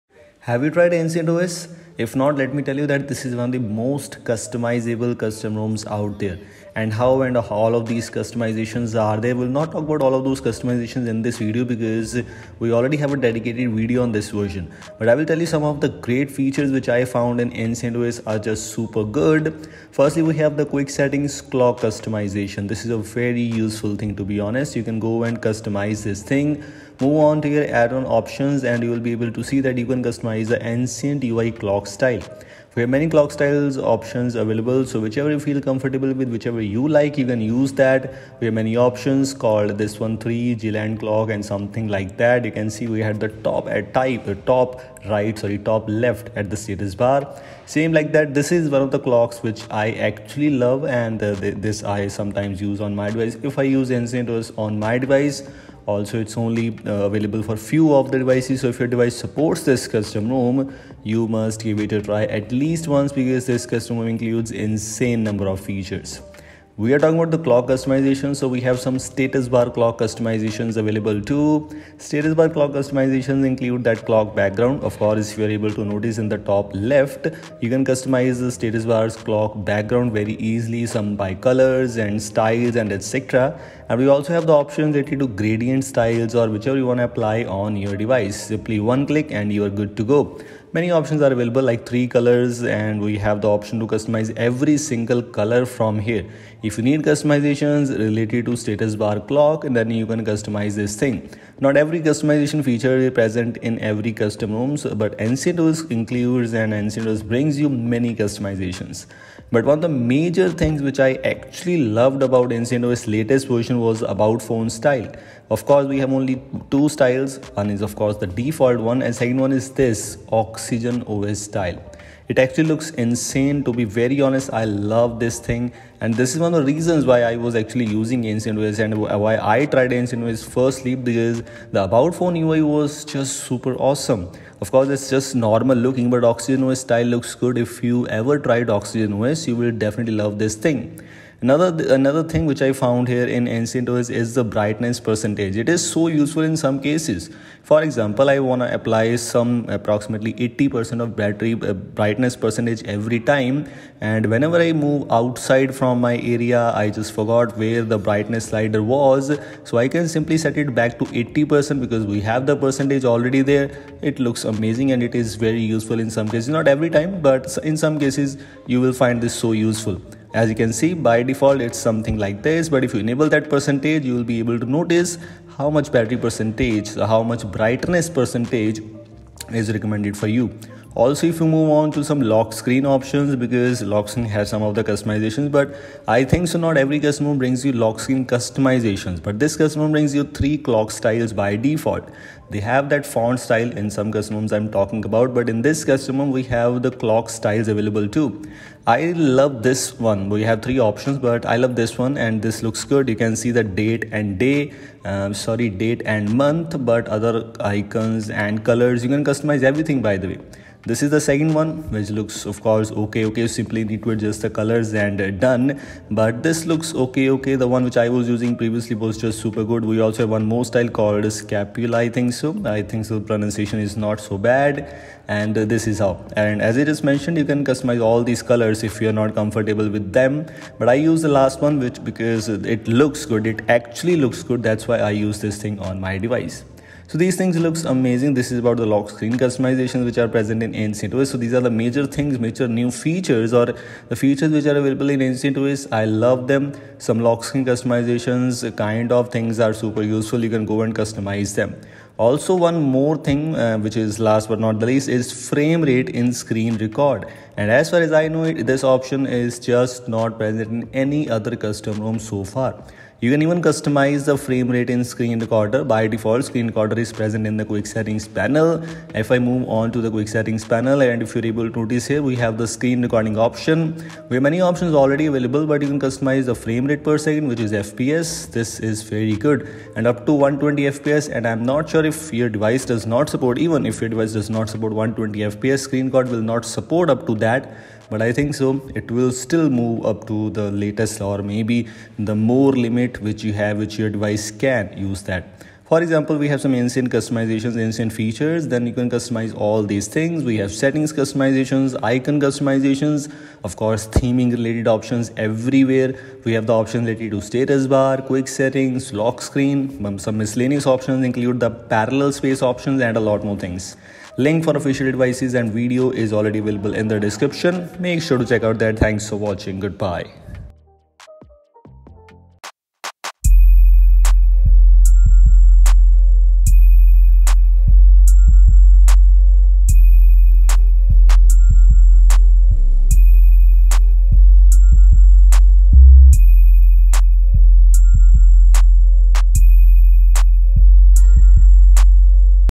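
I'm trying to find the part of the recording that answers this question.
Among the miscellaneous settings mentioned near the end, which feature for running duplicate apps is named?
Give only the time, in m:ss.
5:11.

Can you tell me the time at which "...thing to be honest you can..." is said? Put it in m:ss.
0:23.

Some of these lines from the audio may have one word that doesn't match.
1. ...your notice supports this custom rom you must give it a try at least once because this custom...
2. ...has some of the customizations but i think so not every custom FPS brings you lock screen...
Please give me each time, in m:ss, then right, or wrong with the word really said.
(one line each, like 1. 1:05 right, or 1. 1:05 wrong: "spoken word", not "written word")
1. 0:58 wrong: "device", not "notice"
2. 3:04 wrong: "ROM", not "FPS".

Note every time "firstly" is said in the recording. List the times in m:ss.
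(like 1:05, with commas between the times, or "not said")
0:19, 2:10.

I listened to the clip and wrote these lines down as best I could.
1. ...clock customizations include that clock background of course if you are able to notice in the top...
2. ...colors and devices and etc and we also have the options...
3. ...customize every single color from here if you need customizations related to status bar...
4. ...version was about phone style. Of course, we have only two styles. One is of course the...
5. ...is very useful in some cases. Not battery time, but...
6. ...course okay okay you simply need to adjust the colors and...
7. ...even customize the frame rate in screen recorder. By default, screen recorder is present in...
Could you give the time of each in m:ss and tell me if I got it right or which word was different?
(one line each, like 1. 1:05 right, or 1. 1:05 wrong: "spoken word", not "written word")
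1. 1:12 right
2. 1:21 wrong: "styles", not "devices"
3. 1:33 right
4. 1:53 right
5. 2:45 wrong: "every", not "battery"
6. 3:32 right
7. 4:23 right.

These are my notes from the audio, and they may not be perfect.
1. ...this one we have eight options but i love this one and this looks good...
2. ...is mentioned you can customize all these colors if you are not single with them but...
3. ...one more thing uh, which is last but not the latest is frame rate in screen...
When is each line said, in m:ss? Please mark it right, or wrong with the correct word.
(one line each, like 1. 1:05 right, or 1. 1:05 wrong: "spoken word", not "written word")
1. 3:19 wrong: "three", not "eight"
2. 3:46 wrong: "comfortable", not "single"
3. 4:12 wrong: "least", not "latest".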